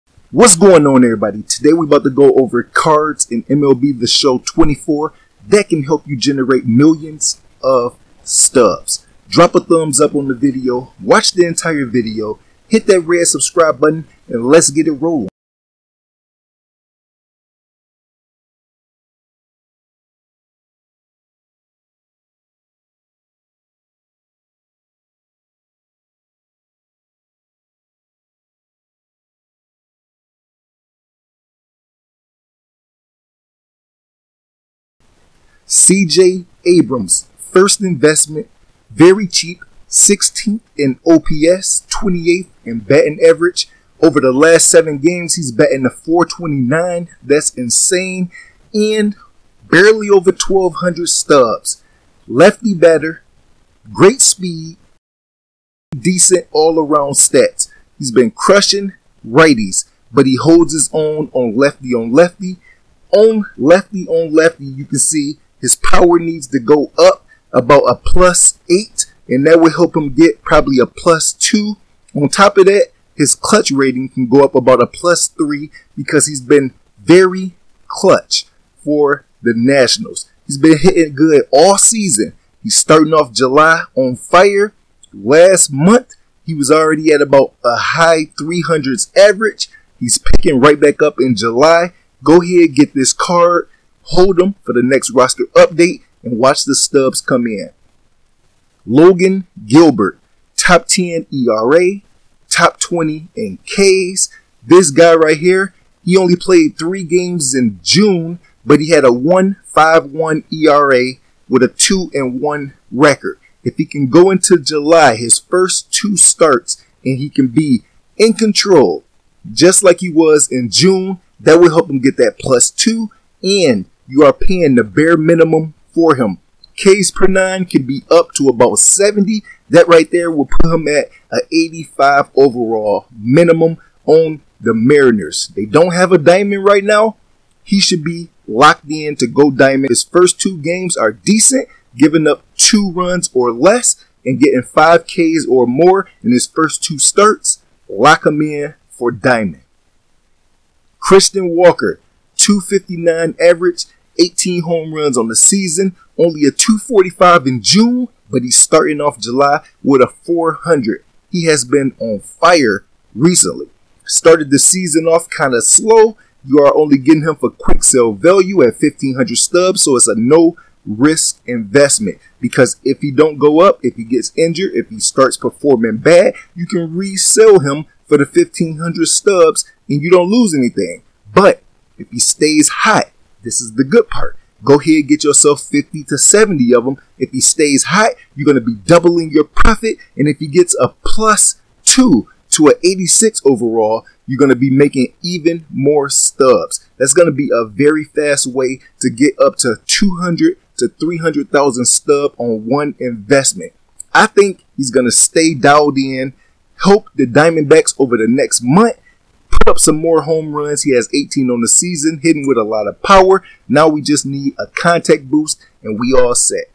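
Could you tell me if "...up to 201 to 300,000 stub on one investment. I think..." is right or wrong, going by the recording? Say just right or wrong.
wrong.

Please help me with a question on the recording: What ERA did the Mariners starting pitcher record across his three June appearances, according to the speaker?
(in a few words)
1.51.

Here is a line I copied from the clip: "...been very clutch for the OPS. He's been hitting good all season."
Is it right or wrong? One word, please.
wrong.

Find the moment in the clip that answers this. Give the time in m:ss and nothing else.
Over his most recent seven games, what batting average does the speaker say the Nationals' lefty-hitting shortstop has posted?
0:45.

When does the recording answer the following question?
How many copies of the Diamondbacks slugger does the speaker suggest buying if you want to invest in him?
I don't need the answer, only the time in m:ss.
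3:05.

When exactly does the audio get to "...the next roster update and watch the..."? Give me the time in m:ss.
1:34.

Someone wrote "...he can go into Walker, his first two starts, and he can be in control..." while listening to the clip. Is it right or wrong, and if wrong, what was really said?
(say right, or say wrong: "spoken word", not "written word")
wrong: "July", not "Walker".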